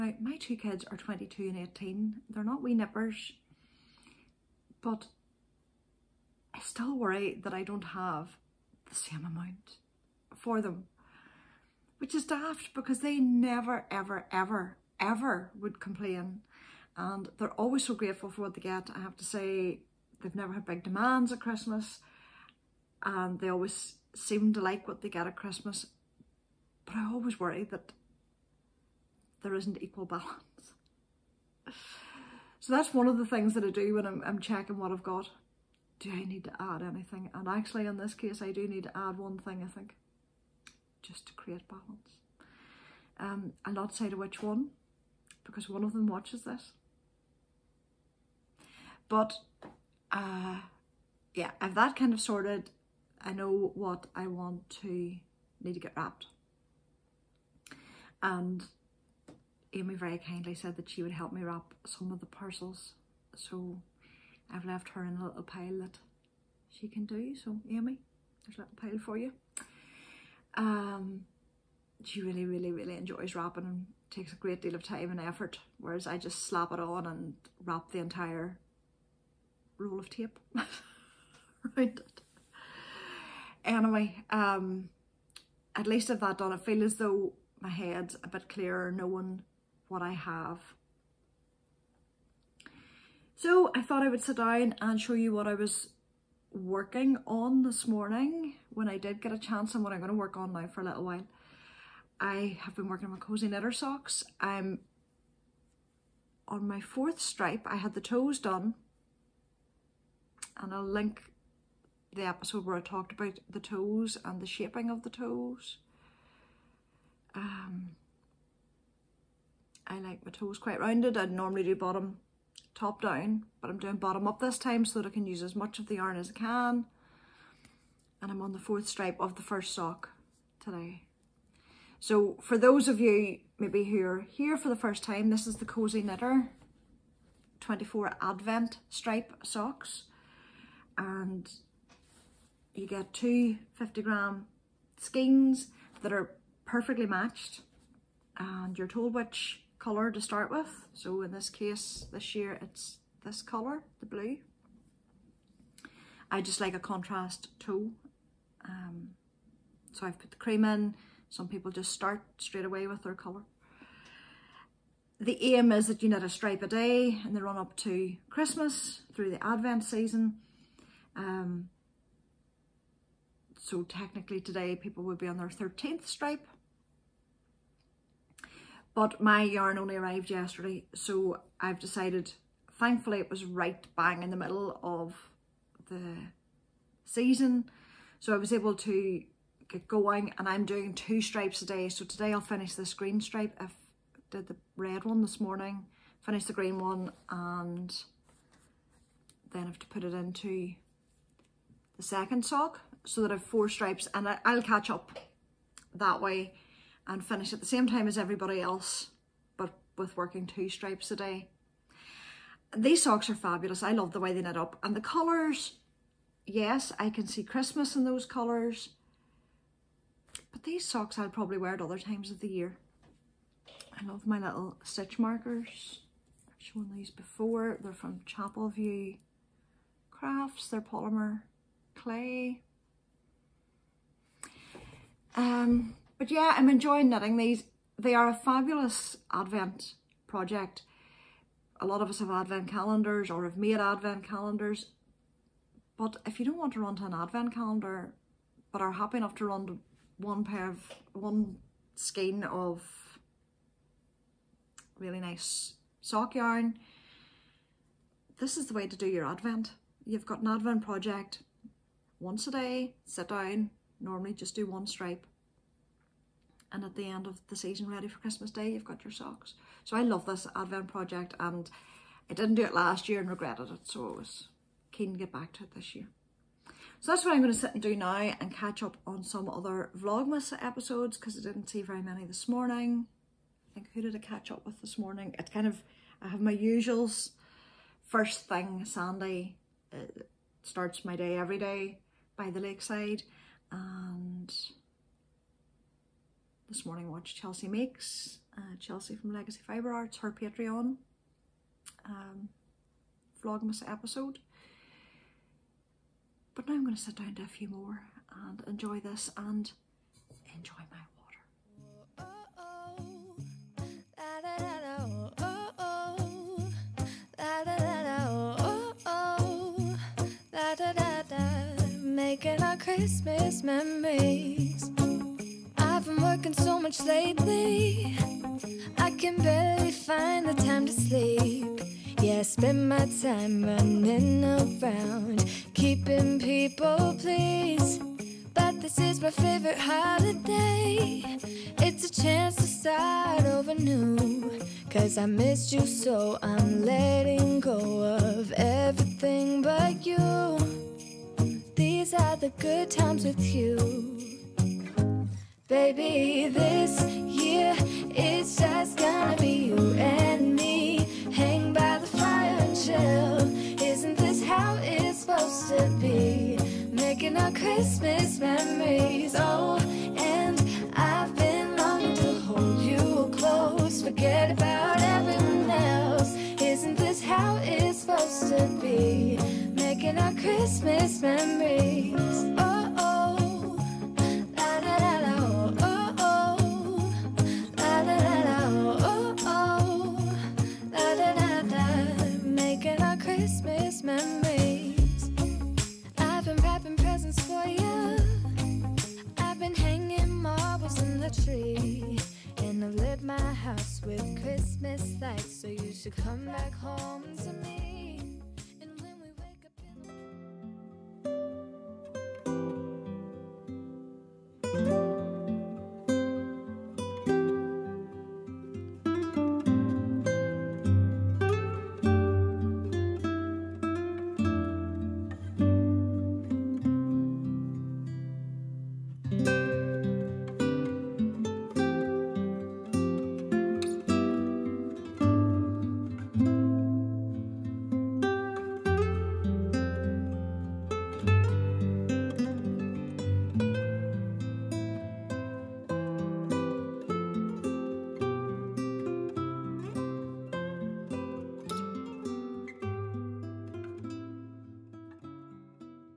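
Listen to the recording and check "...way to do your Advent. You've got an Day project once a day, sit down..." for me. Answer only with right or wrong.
wrong.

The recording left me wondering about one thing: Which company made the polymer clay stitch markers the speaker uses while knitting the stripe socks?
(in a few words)
Chapel View Crafts.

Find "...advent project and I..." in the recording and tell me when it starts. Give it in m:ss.
4:30.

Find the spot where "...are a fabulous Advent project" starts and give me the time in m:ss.
3:58.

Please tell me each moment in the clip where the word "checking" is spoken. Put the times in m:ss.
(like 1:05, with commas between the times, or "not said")
0:34.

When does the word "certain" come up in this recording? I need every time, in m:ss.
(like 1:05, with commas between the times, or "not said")
not said.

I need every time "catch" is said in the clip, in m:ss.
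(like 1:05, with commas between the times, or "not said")
3:24, 4:38, 4:44.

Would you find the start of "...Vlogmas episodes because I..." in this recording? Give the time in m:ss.
4:39.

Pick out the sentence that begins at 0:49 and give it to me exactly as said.
But uh, yeah, I've that kind of sorted.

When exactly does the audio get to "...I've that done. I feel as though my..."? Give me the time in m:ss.
1:26.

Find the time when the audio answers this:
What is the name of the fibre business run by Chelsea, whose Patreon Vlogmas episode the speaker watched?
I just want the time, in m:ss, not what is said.
4:59.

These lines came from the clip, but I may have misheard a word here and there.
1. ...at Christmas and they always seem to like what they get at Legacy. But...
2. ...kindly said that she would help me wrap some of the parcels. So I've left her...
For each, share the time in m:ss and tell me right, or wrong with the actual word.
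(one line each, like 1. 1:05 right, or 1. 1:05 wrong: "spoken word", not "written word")
1. 0:21 wrong: "Christmas", not "Legacy"
2. 1:00 right.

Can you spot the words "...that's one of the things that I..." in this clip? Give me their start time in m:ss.
0:32.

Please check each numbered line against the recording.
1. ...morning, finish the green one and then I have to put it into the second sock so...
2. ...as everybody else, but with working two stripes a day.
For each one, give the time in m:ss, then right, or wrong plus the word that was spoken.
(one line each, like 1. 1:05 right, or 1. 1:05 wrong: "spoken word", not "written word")
1. 3:15 right
2. 3:28 right.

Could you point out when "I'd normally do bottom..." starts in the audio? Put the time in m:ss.
2:01.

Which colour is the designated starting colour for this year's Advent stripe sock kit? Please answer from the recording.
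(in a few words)
Blue.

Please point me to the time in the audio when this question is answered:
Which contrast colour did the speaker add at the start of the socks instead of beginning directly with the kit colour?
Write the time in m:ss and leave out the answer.
2:40.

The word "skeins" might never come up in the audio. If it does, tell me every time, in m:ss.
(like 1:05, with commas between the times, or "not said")
2:24, 4:11.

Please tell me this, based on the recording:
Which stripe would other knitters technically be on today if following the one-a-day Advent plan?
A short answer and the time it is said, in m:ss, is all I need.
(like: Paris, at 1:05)
13th, at 2:55.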